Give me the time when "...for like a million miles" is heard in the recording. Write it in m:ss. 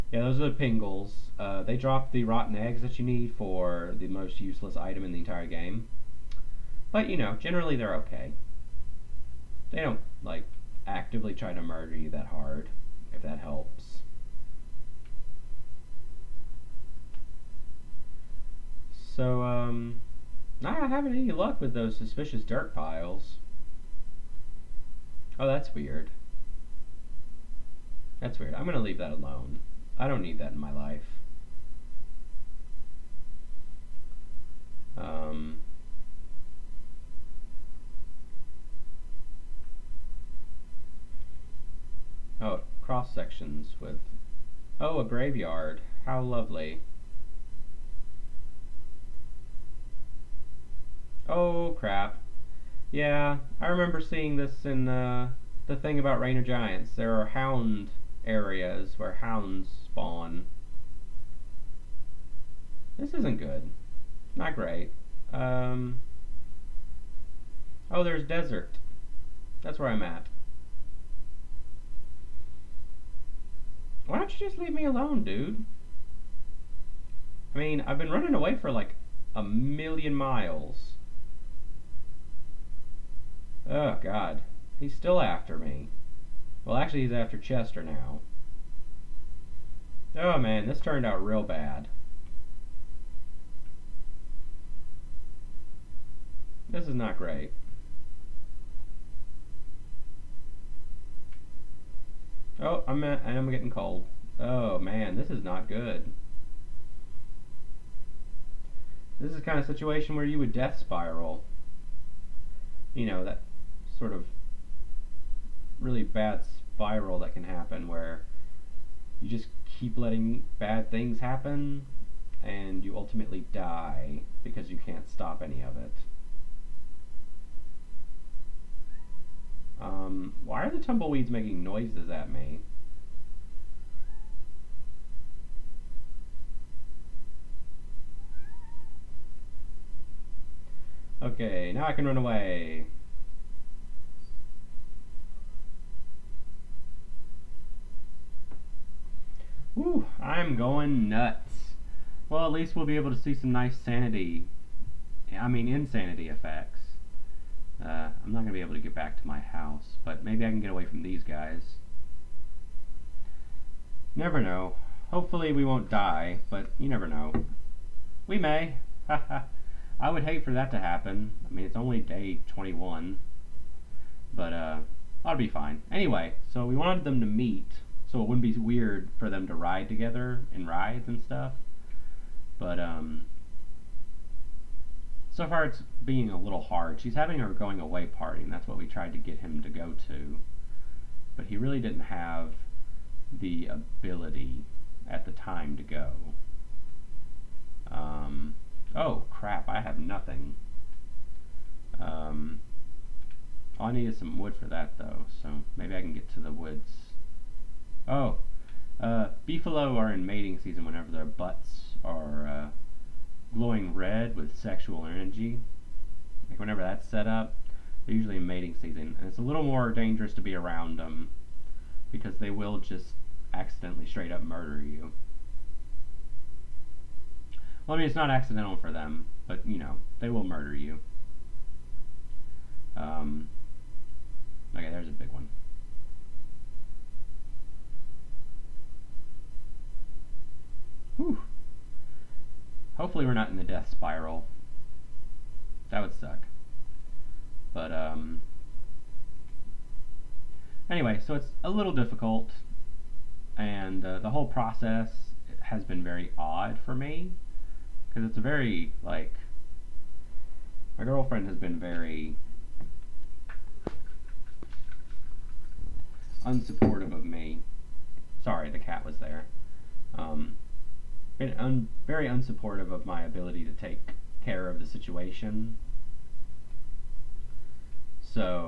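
1:18.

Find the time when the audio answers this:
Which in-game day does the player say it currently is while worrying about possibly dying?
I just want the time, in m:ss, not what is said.
2:52.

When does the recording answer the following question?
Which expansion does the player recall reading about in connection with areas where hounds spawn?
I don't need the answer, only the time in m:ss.
0:56.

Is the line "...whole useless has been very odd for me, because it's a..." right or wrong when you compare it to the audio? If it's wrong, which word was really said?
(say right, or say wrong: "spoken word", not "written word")
wrong: "process", not "useless".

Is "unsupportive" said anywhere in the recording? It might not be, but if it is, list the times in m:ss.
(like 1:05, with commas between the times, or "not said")
4:26, 4:32.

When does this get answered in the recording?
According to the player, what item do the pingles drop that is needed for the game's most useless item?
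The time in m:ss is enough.
0:02.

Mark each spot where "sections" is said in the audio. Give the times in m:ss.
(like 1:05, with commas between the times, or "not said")
0:43.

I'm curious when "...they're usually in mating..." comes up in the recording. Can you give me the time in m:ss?
3:38.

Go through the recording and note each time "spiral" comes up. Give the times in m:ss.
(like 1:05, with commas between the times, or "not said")
1:50, 1:56, 4:03.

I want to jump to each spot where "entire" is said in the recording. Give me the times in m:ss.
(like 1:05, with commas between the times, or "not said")
0:05.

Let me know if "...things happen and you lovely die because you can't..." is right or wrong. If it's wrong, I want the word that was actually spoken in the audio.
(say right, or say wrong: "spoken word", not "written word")
wrong: "ultimately", not "lovely".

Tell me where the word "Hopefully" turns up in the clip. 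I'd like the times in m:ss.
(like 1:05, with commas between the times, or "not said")
2:45, 4:02.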